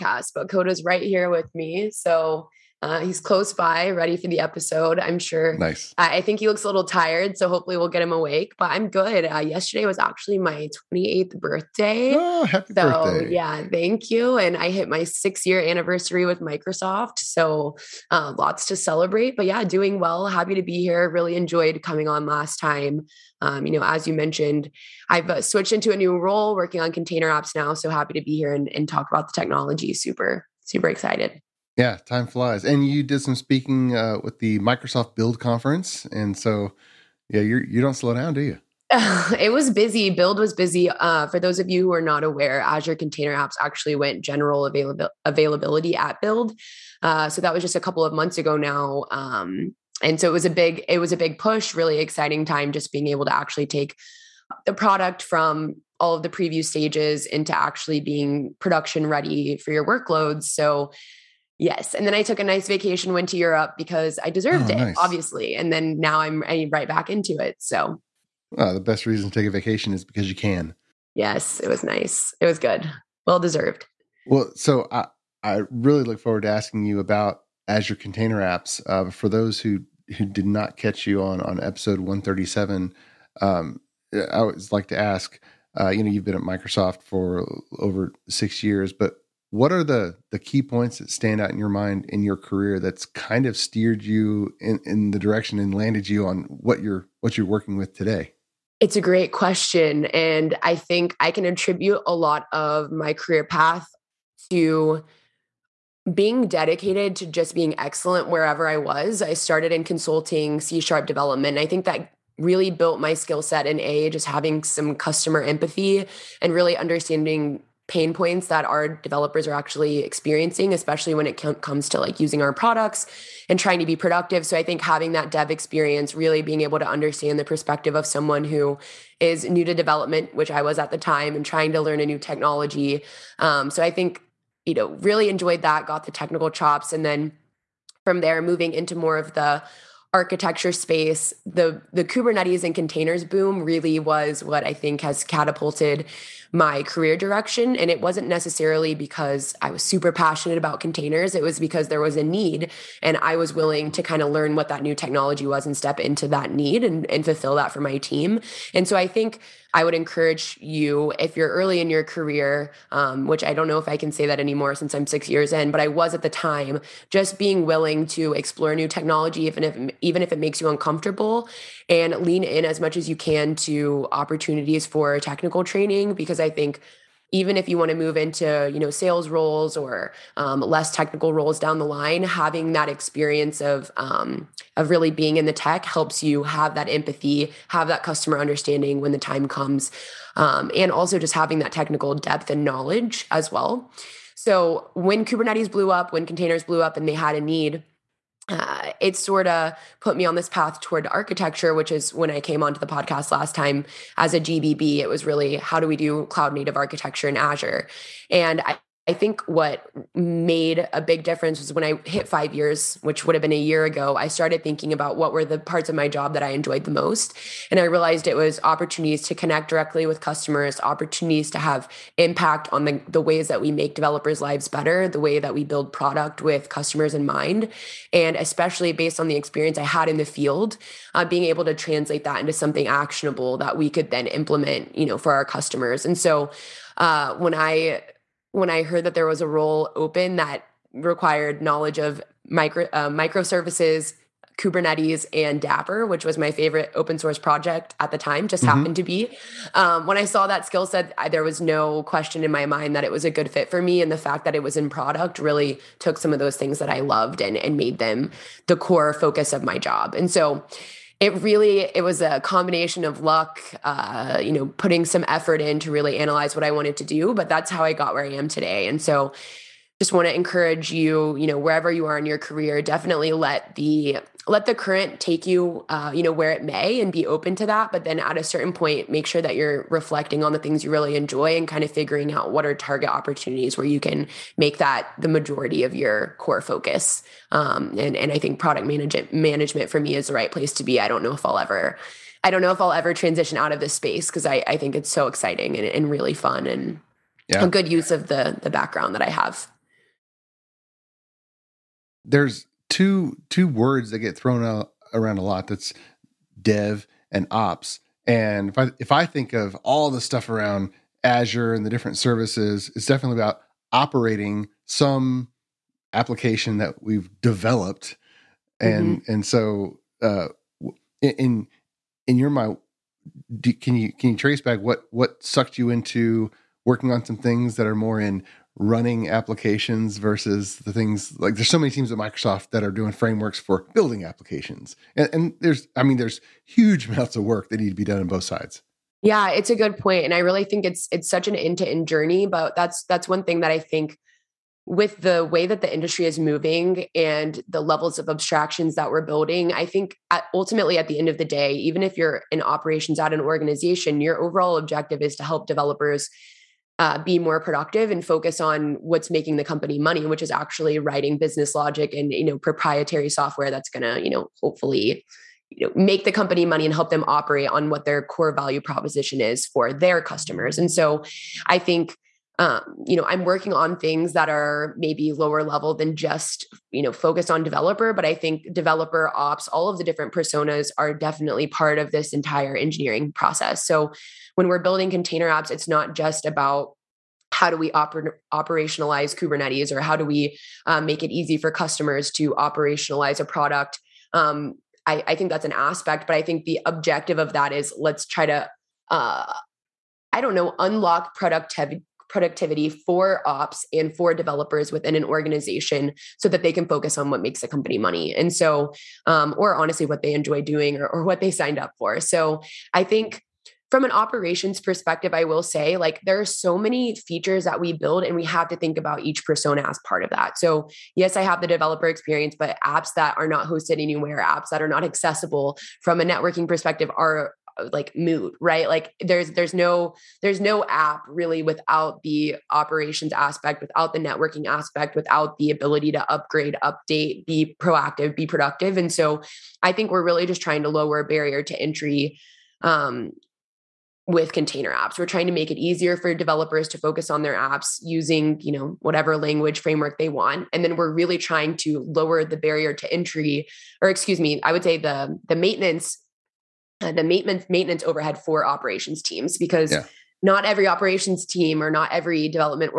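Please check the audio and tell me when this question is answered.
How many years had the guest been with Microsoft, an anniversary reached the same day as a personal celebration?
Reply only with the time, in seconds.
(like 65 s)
15 s.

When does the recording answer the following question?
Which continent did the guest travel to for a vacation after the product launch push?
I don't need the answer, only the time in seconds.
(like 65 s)
63 s.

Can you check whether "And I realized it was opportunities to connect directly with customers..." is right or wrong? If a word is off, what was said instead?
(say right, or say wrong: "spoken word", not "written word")
right.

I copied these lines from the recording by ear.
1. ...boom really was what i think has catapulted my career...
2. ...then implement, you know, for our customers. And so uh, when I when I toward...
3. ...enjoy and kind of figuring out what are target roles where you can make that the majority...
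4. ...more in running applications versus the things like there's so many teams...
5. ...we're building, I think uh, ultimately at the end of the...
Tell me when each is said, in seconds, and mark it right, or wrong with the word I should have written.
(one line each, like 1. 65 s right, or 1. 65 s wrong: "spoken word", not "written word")
1. 143 s right
2. 234 s wrong: "heard", not "toward"
3. 281 s wrong: "opportunities", not "roles"
4. 327 s right
5. 349 s right.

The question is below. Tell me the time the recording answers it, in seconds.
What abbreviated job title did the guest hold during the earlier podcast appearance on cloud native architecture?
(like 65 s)
204 s.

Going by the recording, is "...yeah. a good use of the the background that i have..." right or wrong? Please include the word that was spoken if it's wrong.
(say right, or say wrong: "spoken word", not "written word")
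right.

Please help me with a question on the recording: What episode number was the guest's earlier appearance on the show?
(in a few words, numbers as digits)
137.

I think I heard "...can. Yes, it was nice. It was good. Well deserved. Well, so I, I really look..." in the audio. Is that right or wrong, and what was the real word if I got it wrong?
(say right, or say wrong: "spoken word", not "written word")
right.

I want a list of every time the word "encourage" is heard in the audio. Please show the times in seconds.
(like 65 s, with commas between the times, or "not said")
159 s, 270 s.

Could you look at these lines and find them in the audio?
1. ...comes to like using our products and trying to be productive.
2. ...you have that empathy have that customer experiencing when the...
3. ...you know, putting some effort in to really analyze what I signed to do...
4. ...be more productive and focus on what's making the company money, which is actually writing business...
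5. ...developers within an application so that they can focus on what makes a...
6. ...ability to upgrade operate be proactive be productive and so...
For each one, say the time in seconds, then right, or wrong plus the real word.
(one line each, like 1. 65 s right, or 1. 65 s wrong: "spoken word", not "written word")
1. 121 s right
2. 186 s wrong: "understanding", not "experiencing"
3. 264 s wrong: "wanted", not "signed"
4. 357 s right
5. 404 s wrong: "organization", not "application"
6. 435 s wrong: "update", not "operate".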